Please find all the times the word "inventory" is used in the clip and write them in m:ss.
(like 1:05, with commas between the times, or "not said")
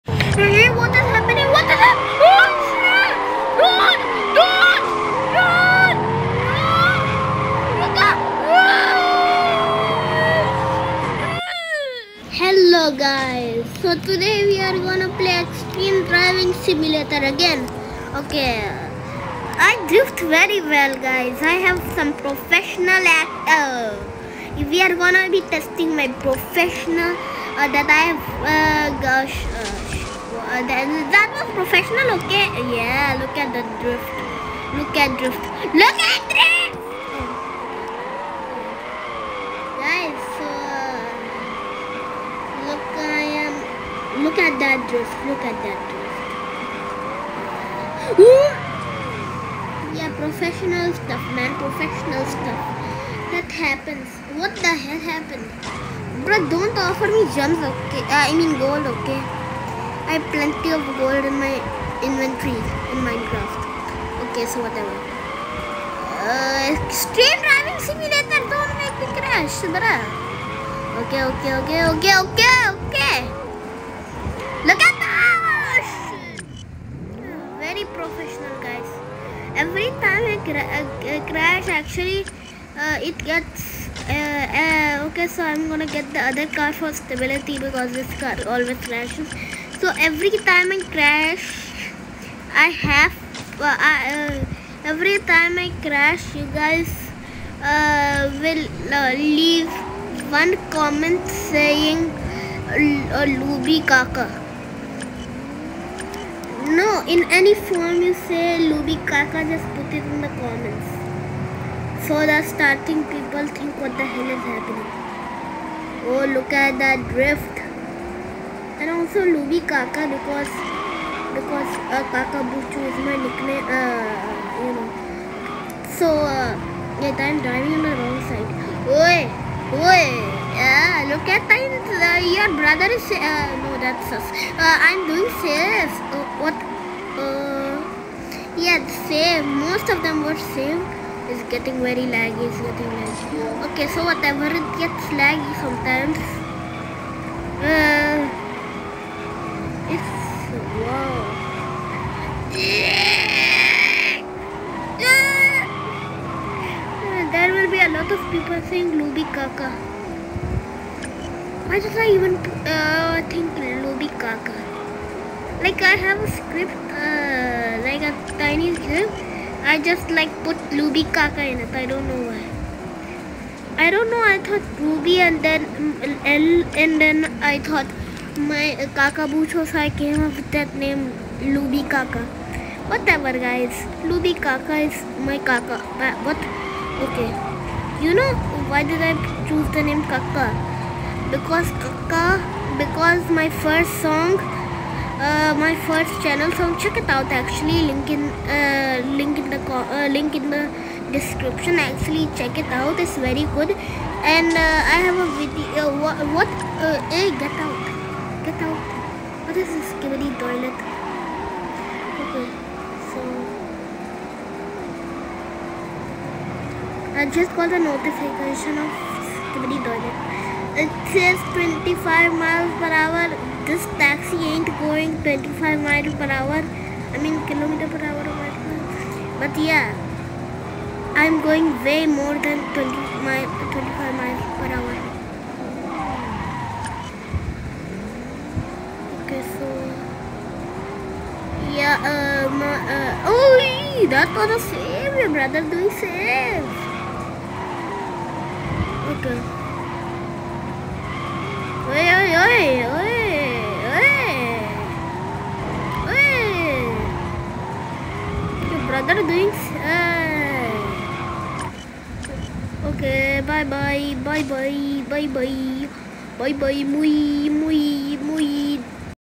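1:02.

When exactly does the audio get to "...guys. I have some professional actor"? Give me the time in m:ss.
0:20.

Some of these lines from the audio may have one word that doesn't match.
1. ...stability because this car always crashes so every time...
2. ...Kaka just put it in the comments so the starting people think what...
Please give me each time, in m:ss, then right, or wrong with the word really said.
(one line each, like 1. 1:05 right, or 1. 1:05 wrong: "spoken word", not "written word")
1. 1:26 right
2. 1:49 right.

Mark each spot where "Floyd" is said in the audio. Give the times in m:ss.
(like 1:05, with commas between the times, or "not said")
not said.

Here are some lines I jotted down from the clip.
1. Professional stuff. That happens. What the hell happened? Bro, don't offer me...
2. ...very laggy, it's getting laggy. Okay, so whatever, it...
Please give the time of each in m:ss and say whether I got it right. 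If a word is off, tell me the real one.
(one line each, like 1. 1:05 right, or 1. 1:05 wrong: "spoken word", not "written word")
1. 0:51 right
2. 2:21 right.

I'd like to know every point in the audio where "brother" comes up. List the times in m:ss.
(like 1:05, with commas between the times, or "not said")
2:12, 4:05, 4:18.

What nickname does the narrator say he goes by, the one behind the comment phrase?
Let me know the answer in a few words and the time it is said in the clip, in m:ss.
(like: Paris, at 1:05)
Kaka Buchu, at 2:02.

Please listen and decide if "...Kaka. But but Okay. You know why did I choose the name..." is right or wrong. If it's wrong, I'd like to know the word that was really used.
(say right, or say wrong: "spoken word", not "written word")
right.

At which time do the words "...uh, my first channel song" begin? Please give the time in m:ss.
3:15.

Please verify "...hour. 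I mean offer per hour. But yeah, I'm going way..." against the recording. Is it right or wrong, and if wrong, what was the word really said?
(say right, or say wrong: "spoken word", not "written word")
wrong: "kilometer", not "offer".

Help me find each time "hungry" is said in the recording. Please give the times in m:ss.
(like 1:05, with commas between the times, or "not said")
not said.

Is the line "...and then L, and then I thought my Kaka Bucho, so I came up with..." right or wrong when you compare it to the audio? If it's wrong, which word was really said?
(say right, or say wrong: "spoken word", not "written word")
right.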